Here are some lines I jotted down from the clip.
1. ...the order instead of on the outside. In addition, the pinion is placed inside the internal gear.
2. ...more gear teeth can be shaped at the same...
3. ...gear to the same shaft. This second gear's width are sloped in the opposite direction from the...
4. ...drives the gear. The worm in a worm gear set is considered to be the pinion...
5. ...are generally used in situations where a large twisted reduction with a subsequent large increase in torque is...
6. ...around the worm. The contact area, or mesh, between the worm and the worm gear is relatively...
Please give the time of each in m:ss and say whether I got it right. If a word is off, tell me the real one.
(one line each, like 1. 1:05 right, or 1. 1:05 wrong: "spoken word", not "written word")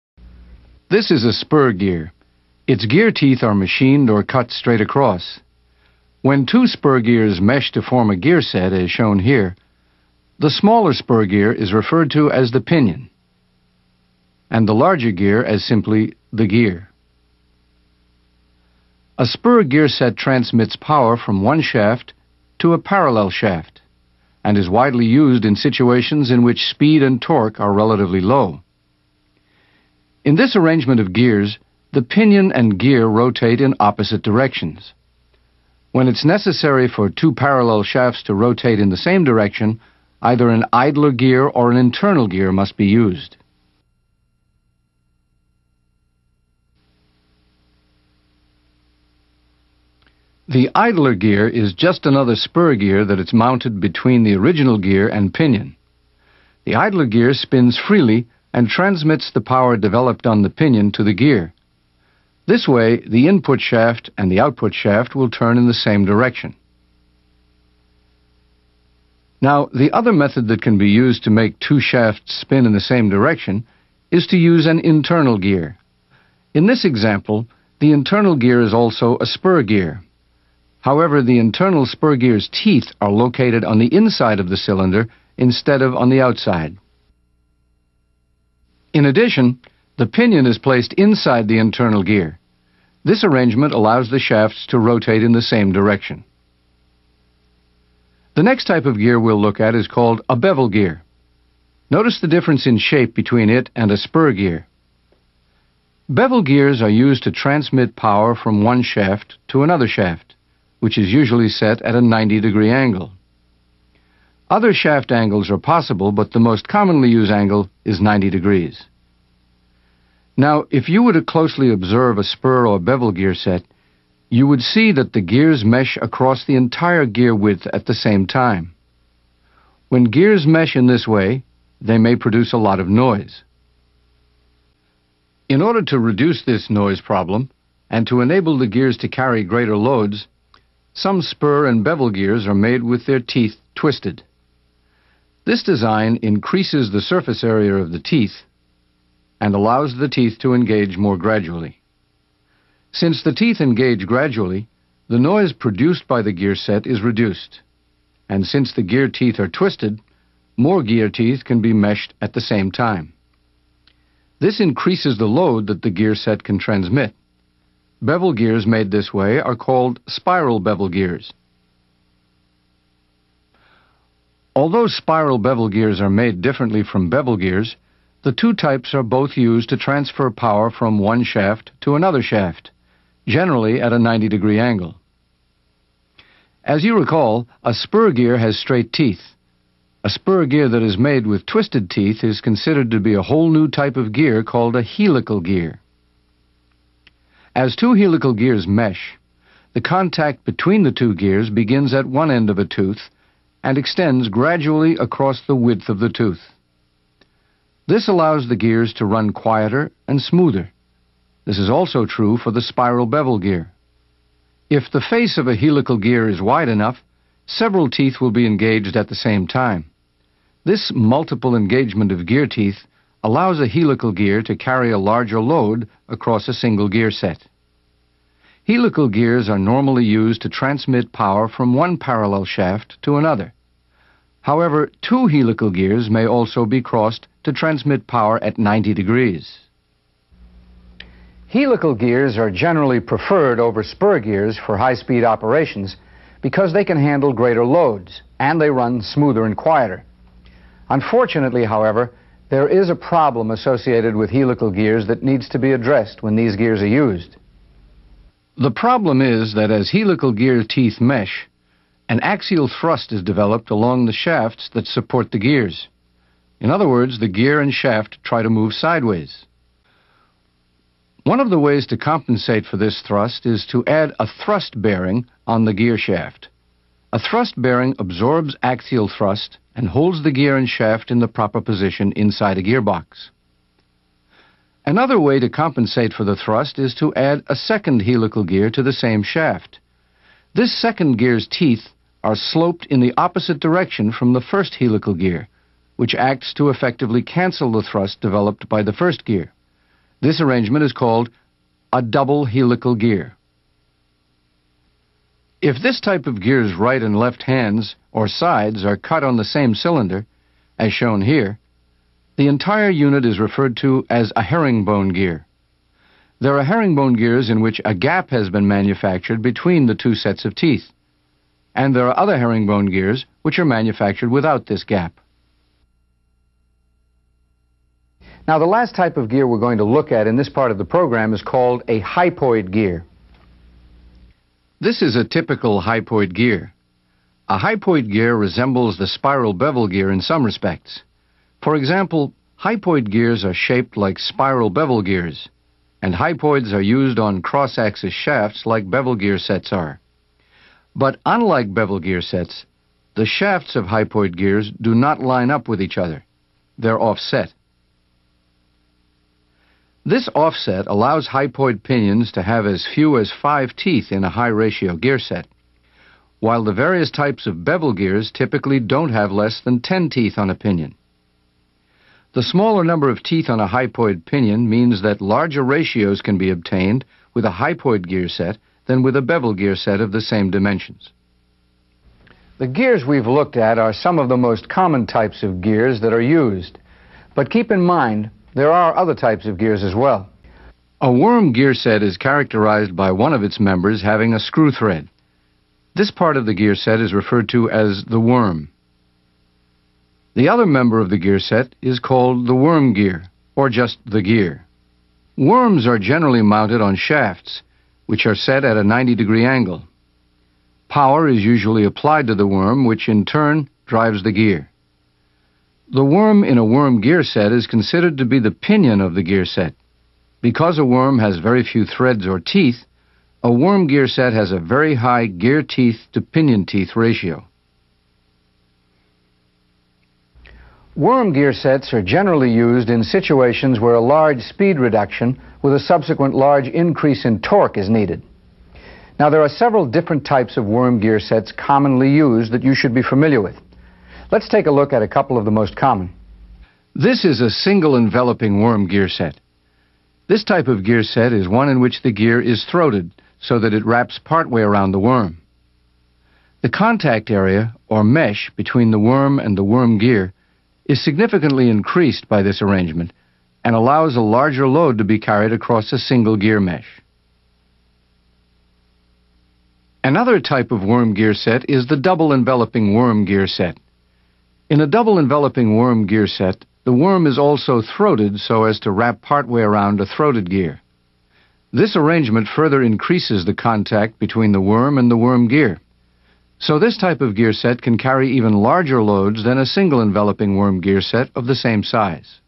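1. 1:24 wrong: "cylinder", not "order"
2. 2:40 wrong: "meshed", not "shaped"
3. 4:48 wrong: "teeth", not "width"
4. 6:53 right
5. 7:11 wrong: "speed", not "twisted"
6. 7:34 wrong: "significantly", not "relatively".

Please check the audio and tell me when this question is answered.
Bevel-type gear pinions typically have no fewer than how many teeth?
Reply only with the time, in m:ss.
6:09.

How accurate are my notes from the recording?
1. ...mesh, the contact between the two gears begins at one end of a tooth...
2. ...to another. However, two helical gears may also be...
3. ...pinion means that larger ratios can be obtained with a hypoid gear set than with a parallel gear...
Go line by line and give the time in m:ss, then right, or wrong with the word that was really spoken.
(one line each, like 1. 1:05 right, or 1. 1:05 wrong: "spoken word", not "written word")
1. 3:18 right
2. 3:53 right
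3. 6:14 wrong: "bevel", not "parallel".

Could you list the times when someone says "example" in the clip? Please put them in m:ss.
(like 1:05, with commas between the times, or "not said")
1:16, 5:41.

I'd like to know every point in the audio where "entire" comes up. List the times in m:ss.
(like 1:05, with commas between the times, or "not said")
2:06, 5:12.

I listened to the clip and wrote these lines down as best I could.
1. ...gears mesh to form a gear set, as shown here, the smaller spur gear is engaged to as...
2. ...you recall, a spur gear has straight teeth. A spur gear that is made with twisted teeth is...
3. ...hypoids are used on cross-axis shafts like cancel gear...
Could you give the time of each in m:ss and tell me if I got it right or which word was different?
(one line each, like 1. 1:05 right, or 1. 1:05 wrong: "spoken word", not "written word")
1. 0:06 wrong: "referred", not "engaged"
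2. 3:06 right
3. 5:46 wrong: "bevel", not "cancel".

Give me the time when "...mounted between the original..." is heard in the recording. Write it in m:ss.
0:53.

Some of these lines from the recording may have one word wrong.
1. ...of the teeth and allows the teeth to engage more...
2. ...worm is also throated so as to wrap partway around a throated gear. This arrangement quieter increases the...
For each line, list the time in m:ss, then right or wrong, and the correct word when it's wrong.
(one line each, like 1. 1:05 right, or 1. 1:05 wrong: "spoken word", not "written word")
1. 2:27 right
2. 7:56 wrong: "further", not "quieter".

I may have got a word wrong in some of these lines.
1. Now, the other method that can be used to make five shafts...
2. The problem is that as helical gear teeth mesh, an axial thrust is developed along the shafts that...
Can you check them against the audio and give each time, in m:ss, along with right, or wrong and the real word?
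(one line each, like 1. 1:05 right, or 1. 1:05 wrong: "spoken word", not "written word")
1. 1:09 wrong: "two", not "five"
2. 4:18 right.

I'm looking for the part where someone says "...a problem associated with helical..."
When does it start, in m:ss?
4:12.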